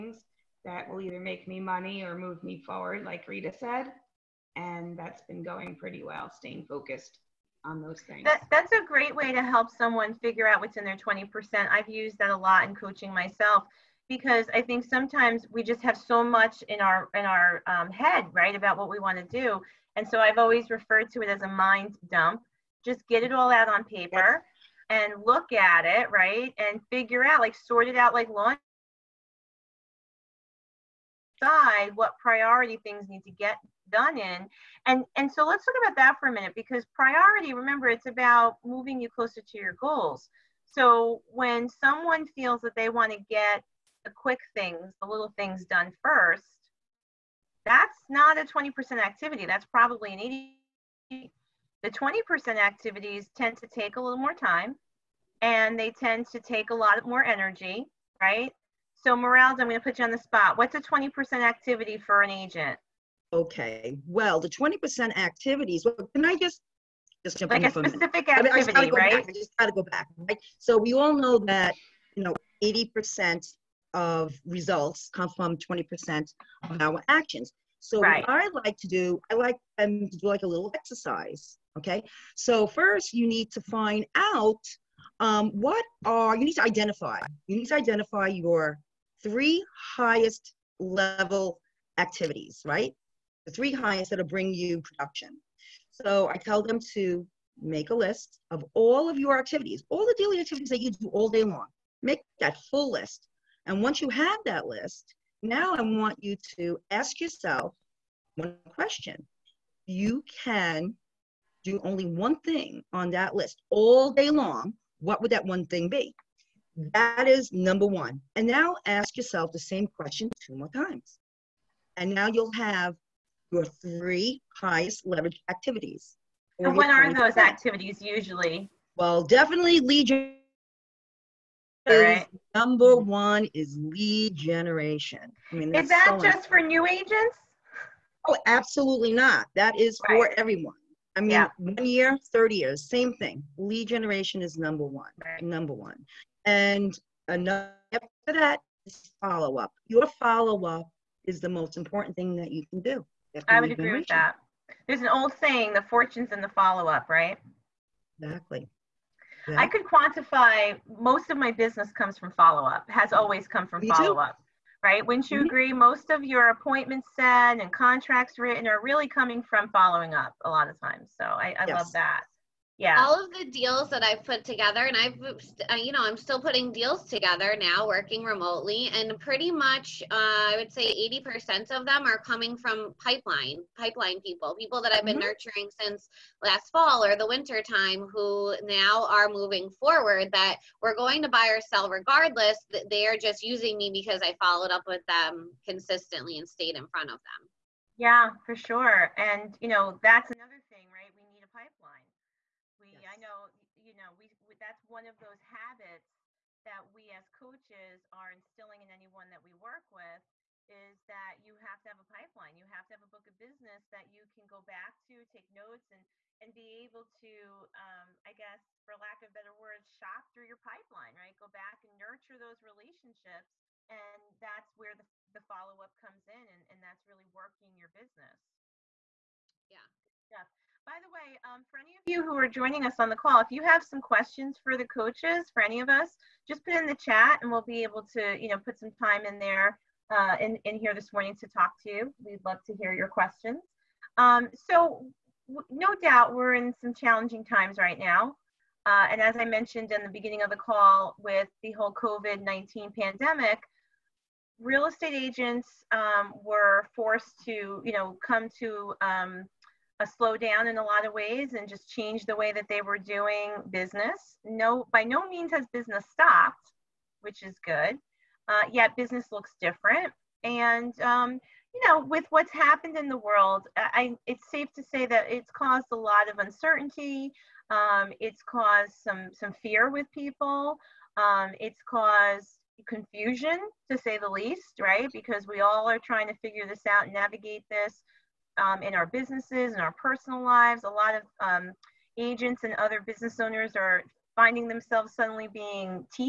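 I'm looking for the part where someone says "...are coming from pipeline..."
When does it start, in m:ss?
3:02.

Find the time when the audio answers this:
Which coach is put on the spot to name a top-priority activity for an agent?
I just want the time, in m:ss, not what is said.
0:59.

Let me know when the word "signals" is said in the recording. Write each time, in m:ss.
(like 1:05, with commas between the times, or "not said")
not said.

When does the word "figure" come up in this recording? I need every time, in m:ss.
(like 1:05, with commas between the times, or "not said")
0:10, 0:26, 4:46.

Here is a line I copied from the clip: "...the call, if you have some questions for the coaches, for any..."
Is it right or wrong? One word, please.
right.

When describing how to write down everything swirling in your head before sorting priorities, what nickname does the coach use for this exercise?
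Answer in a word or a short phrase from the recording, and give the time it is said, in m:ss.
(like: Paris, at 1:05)
mind dump, at 0:21.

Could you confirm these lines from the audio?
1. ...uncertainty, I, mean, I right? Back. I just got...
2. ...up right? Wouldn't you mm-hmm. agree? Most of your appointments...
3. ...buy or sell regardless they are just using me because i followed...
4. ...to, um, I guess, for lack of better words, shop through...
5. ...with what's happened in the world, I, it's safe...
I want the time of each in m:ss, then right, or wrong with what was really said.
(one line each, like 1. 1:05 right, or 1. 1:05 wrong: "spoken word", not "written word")
1. 1:08 wrong: "activity", not "uncertainty"
2. 2:44 right
3. 3:11 right
4. 3:37 right
5. 4:32 right.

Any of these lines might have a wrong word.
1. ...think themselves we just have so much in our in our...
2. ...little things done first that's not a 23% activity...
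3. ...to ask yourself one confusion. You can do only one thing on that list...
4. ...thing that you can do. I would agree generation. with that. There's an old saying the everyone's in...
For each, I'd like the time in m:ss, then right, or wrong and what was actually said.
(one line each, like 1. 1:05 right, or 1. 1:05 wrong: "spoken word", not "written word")
1. 0:14 wrong: "sometimes", not "themselves"
2. 0:45 wrong: "20", not "23"
3. 1:46 wrong: "question", not "confusion"
4. 2:32 wrong: "fortune", not "everyone".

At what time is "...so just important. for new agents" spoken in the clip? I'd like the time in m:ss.
2:16.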